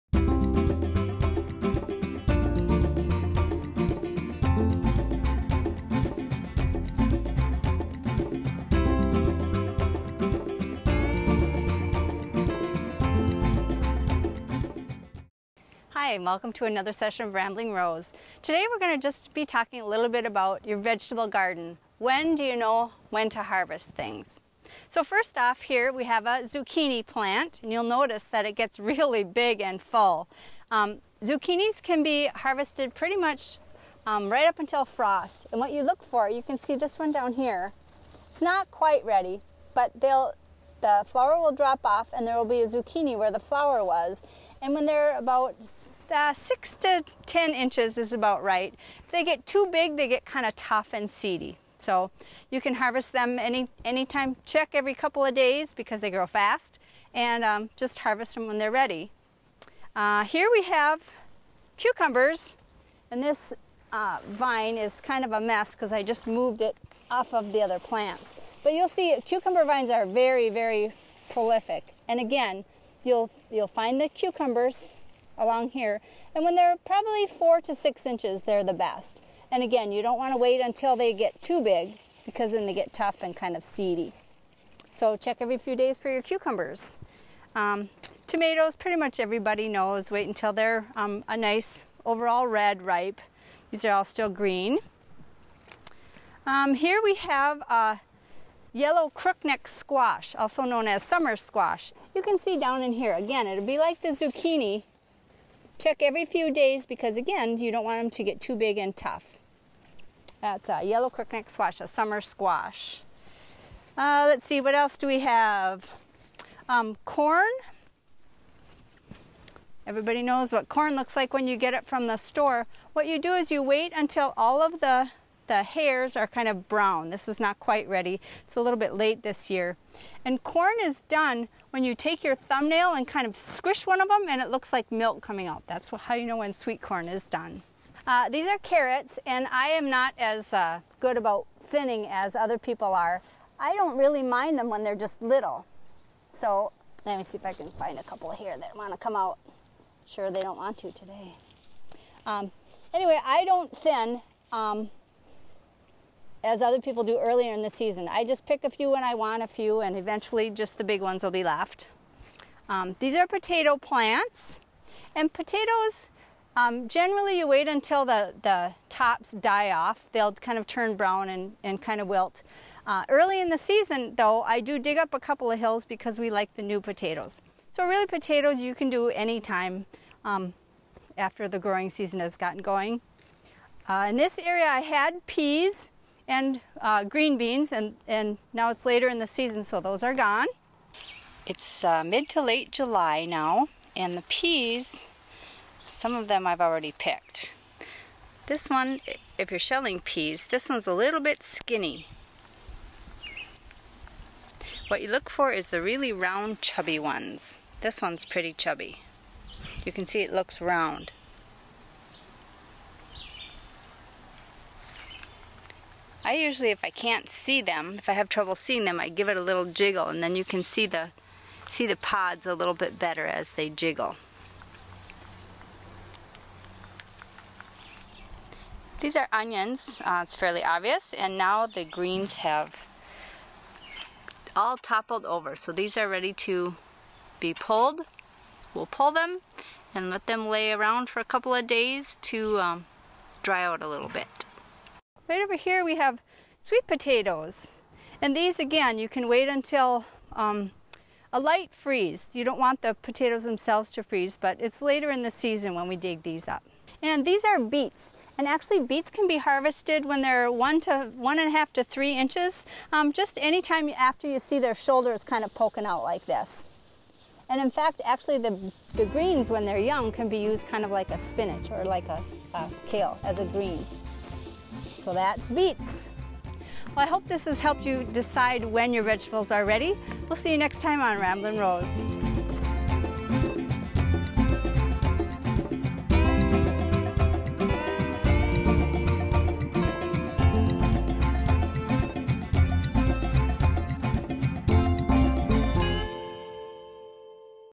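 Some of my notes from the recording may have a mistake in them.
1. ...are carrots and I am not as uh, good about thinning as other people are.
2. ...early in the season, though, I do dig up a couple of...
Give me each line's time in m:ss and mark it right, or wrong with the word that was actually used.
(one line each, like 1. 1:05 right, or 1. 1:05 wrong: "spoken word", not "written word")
1. 2:18 right
2. 2:53 right.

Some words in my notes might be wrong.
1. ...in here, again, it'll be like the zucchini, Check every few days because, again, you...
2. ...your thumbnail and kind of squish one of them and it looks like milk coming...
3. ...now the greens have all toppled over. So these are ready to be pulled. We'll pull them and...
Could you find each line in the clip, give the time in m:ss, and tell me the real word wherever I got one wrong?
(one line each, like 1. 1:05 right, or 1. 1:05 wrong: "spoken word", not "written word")
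1. 1:42 right
2. 2:12 right
3. 3:51 right.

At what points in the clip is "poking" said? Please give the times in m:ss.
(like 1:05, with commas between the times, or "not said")
4:25.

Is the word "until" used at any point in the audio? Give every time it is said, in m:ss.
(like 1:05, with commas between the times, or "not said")
0:34, 1:20, 1:30, 2:03, 2:47, 4:09.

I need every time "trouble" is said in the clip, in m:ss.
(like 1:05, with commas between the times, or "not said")
3:38.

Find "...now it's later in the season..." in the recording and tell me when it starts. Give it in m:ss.
3:08.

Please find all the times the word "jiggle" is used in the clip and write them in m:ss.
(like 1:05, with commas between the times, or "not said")
3:39, 3:43.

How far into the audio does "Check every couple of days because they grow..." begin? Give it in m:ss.
0:54.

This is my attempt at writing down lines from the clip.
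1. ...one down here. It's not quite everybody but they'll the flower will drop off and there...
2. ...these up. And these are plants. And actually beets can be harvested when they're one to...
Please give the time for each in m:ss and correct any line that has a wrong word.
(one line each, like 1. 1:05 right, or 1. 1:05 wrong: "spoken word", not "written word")
1. 0:36 wrong: "ready", not "everybody"
2. 4:16 wrong: "beets", not "plants".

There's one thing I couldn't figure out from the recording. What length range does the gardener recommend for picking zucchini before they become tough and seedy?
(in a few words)
6 to 10 inches.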